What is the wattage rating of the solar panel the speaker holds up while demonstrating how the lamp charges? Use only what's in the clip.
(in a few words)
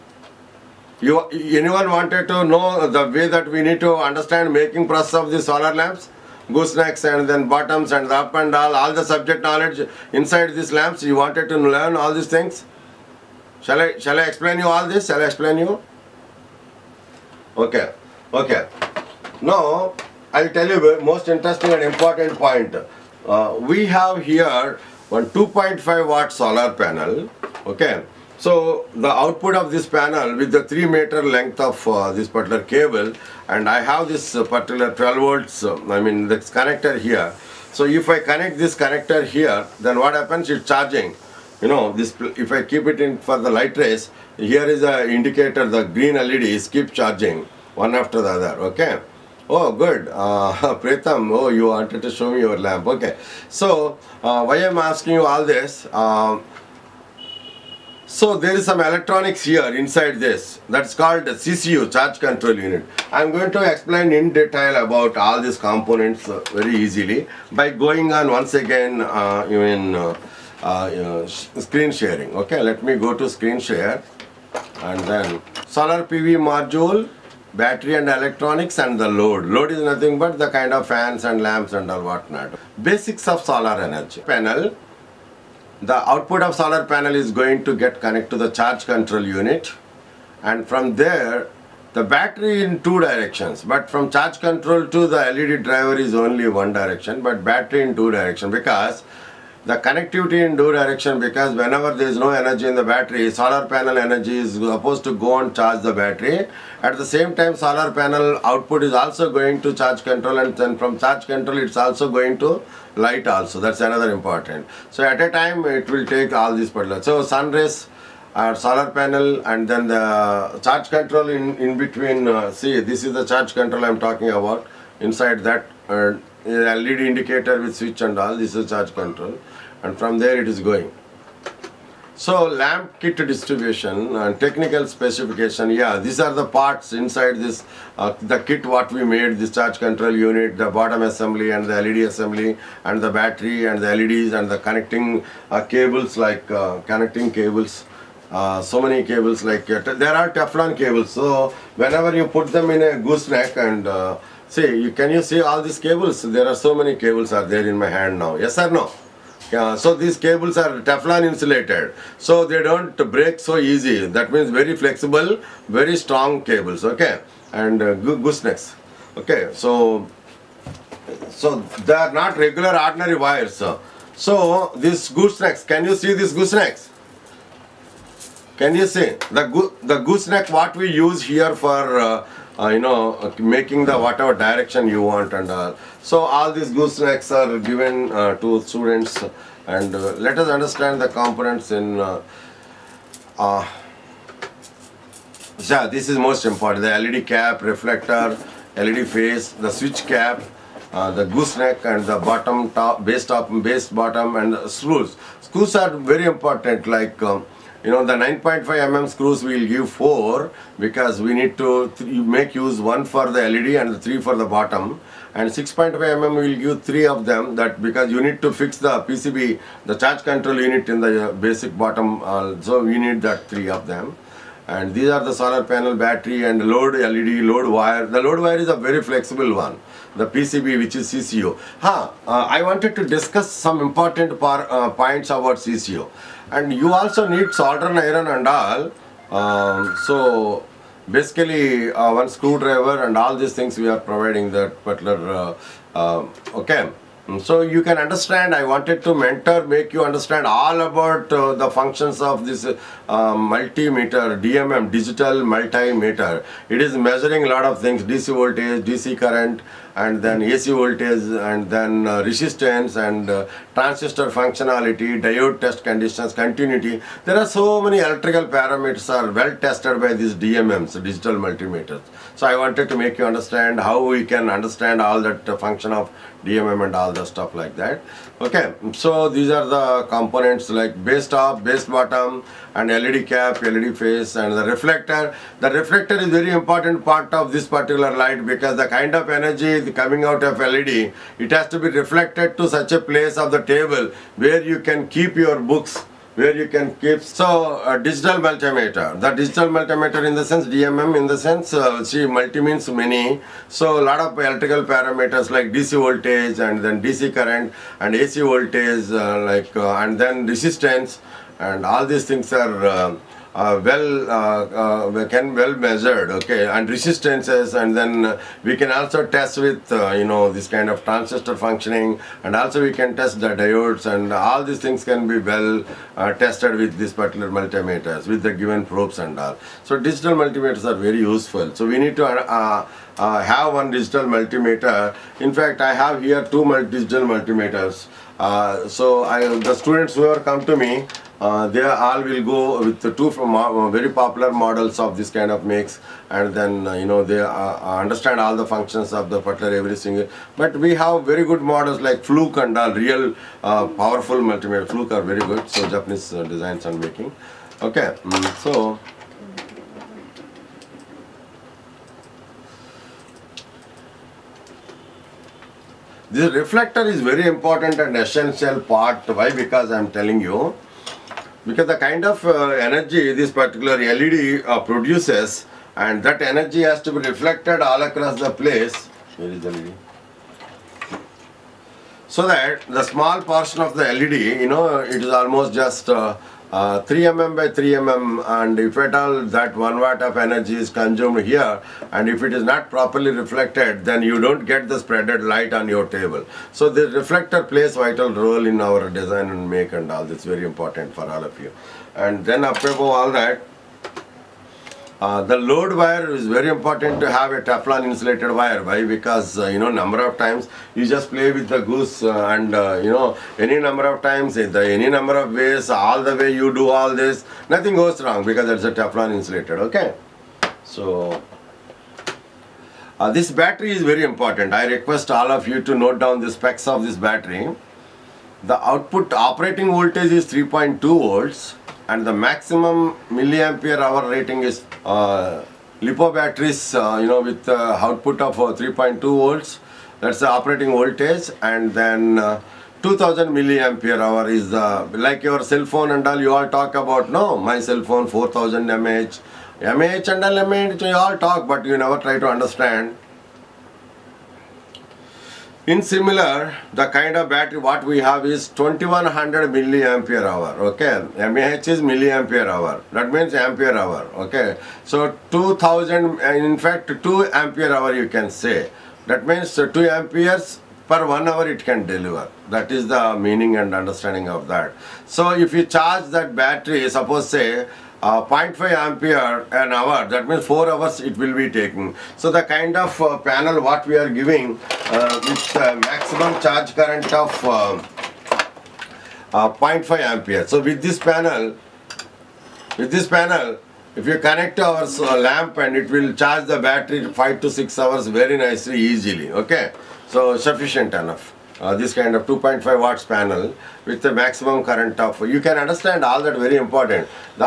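2.5 watt.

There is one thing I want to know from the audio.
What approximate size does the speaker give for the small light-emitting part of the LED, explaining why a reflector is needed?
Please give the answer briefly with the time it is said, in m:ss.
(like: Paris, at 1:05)
3 mm by 3 mm, at 6:27.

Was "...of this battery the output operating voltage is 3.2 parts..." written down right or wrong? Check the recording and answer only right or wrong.
wrong.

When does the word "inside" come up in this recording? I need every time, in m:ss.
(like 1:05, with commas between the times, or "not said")
0:10, 0:59, 2:05, 2:16.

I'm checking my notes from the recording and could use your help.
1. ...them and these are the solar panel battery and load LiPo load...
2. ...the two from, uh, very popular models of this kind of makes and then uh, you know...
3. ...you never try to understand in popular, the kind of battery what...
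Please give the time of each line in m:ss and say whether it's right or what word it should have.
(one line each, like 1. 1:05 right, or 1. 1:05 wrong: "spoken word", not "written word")
1. 3:43 wrong: "LED", not "LiPo"
2. 5:42 right
3. 7:31 wrong: "similar", not "popular".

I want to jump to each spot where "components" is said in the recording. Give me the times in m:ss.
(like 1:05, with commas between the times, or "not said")
1:05, 3:11, 4:40.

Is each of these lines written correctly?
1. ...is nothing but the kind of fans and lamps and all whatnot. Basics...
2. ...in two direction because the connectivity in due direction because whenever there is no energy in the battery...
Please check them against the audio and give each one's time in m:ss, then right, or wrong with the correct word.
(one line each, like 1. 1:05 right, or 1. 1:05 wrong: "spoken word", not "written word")
1. 1:19 right
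2. 1:37 right.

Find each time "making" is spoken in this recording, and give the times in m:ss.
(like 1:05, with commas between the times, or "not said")
0:04, 3:03, 5:56.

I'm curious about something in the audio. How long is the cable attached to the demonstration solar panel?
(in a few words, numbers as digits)
3 meters.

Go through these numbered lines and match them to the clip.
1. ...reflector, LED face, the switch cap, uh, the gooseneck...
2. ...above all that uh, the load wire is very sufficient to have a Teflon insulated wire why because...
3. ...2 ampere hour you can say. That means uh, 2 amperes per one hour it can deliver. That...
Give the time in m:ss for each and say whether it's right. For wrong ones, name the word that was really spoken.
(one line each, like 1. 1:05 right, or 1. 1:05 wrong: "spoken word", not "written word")
1. 3:17 right
2. 6:42 wrong: "important", not "sufficient"
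3. 7:47 right.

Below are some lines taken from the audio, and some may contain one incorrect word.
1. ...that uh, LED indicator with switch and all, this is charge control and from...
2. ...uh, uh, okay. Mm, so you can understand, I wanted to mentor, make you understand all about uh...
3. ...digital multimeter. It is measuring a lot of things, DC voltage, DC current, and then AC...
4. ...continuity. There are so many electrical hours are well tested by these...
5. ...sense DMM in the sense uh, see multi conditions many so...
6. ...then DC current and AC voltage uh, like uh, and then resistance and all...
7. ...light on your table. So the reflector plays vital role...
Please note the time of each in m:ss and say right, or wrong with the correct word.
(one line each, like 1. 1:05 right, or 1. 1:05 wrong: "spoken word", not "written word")
1. 2:05 right
2. 4:05 right
3. 4:14 right
4. 4:26 wrong: "parameters", not "hours"
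5. 5:00 wrong: "means", not "conditions"
6. 5:06 right
7. 6:35 right.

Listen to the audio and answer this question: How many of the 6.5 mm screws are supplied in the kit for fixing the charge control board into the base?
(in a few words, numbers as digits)
3.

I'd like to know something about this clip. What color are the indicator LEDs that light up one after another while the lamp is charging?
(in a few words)
Green.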